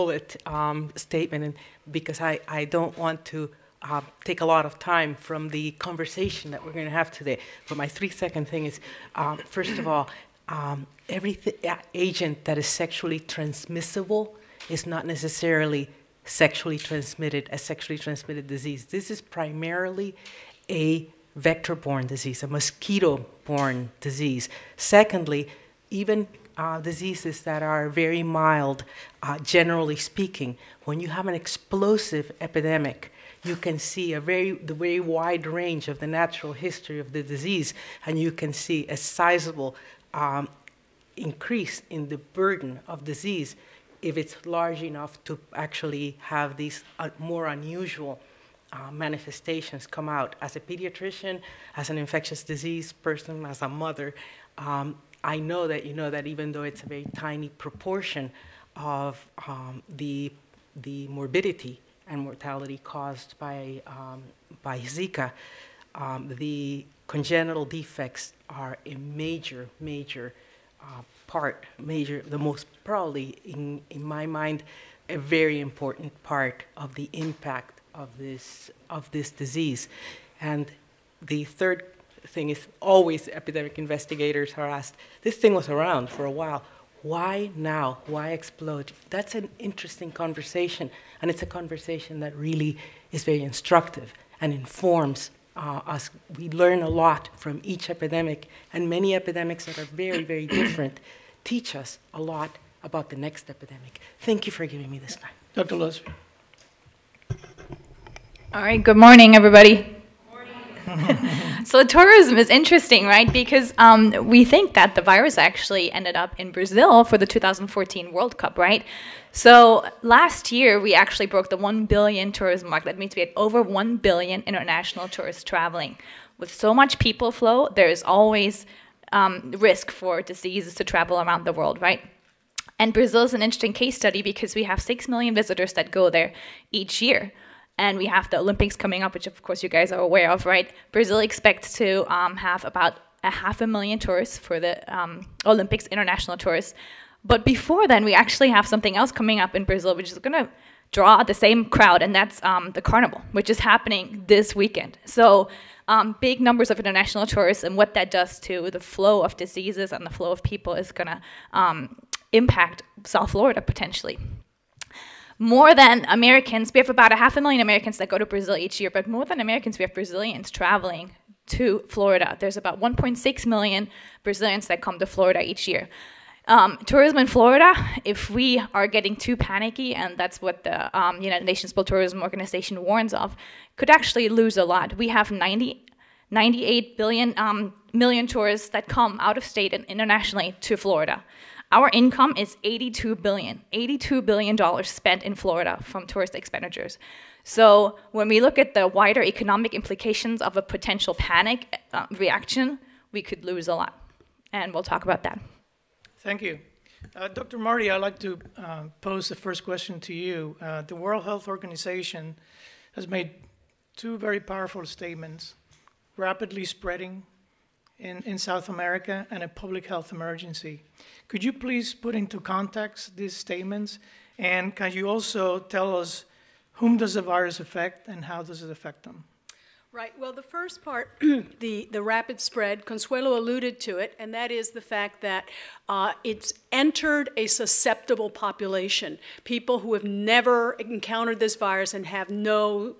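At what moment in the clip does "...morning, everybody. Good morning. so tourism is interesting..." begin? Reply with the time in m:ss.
1:48.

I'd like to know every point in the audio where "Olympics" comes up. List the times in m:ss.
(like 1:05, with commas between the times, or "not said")
2:18, 2:25.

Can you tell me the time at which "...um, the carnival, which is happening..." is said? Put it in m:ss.
2:32.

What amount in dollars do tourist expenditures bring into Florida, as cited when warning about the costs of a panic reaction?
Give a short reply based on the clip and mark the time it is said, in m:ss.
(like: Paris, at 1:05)
$82 billion, at 3:13.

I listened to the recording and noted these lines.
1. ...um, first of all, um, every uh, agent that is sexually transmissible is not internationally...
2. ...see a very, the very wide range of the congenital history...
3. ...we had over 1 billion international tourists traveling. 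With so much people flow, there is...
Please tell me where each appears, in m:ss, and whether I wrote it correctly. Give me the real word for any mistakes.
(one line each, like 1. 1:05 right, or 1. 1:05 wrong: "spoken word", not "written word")
1. 0:09 wrong: "necessarily", not "internationally"
2. 0:33 wrong: "natural", not "congenital"
3. 2:03 right.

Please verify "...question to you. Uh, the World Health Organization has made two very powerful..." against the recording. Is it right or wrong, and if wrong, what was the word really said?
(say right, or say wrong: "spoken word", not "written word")
right.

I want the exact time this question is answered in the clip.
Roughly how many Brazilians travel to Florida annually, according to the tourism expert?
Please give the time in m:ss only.
2:52.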